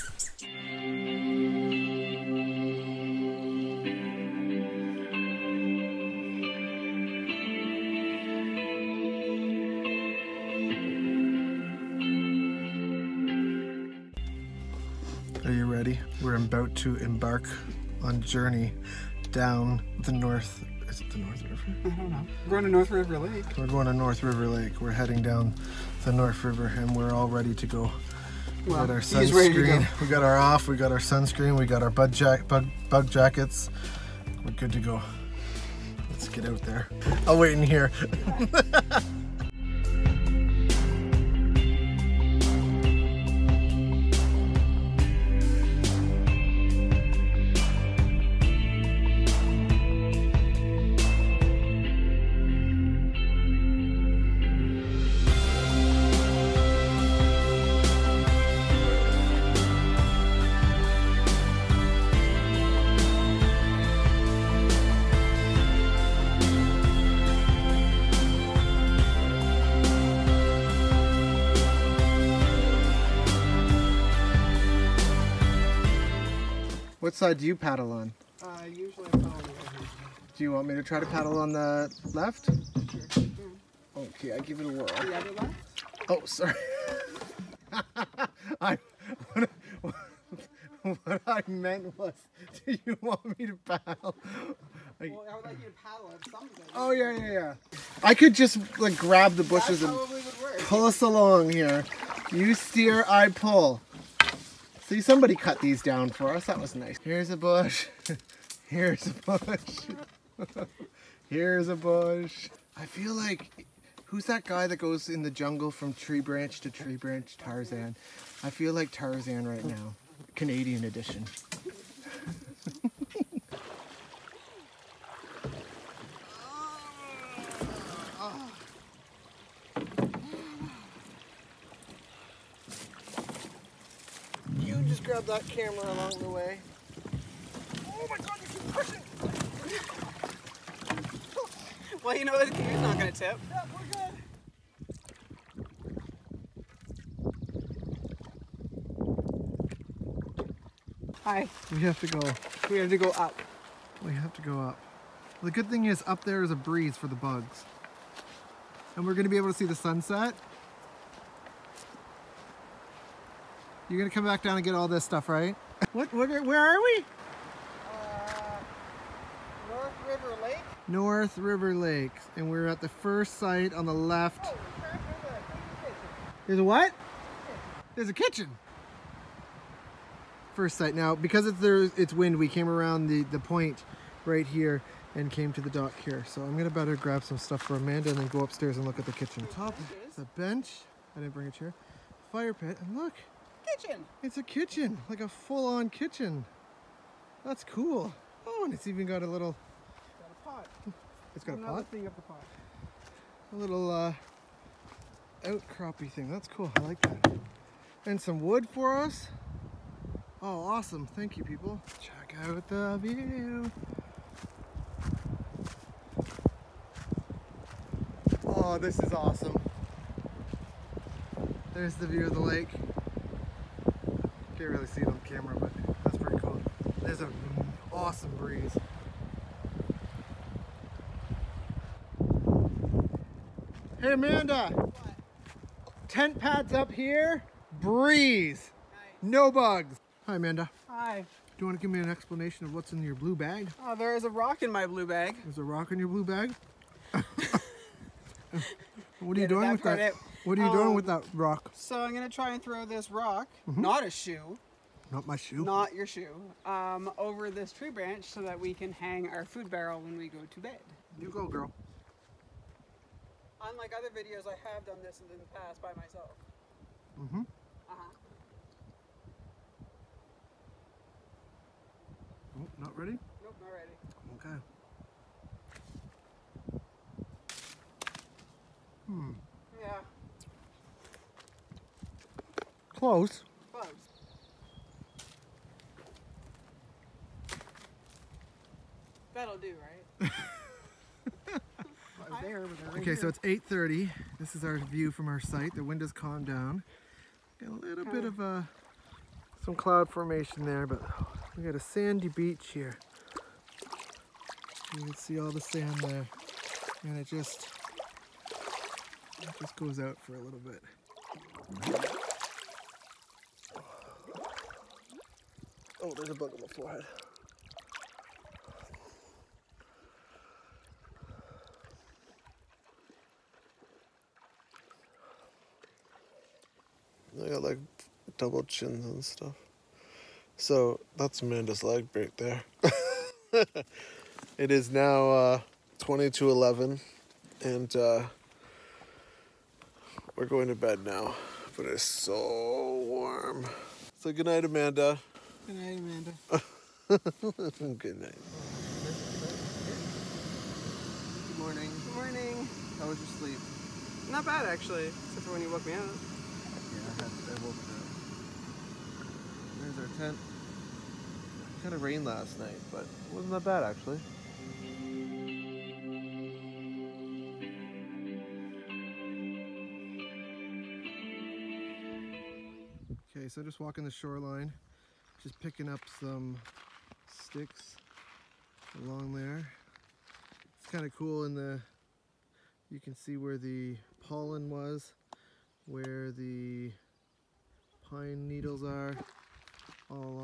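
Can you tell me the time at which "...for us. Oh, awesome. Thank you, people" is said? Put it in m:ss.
3:28.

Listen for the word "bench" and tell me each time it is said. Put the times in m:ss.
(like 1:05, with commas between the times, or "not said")
3:10.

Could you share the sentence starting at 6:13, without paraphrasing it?
Okay, so just walking the shoreline.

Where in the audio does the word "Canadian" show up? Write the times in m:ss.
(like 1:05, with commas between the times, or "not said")
2:00.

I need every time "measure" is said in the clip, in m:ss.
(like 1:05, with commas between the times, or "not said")
not said.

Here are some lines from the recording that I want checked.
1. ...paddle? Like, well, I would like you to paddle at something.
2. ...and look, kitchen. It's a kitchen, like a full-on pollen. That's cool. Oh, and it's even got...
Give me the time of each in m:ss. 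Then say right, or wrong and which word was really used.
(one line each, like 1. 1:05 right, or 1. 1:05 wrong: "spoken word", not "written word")
1. 1:33 right
2. 3:12 wrong: "kitchen", not "pollen".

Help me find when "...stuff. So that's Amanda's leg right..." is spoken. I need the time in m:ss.
5:29.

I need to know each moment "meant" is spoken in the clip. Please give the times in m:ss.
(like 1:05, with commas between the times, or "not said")
1:31.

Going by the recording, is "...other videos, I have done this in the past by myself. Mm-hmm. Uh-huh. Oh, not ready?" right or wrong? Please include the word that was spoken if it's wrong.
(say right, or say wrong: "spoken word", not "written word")
right.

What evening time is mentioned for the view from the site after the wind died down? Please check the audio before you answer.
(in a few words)
8:30.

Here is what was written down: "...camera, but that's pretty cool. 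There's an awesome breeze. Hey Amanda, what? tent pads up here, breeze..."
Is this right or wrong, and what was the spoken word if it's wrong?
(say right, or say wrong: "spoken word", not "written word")
right.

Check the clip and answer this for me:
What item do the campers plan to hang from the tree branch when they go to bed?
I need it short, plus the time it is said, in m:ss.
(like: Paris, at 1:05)
Food barrel, at 4:19.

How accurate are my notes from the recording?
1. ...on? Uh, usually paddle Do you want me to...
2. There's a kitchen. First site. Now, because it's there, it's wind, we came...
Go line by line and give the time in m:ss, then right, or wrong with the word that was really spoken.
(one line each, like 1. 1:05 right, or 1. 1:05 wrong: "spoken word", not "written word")
1. 1:17 right
2. 2:57 right.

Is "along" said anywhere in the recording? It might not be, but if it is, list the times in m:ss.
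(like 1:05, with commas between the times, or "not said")
1:41, 2:15, 6:19.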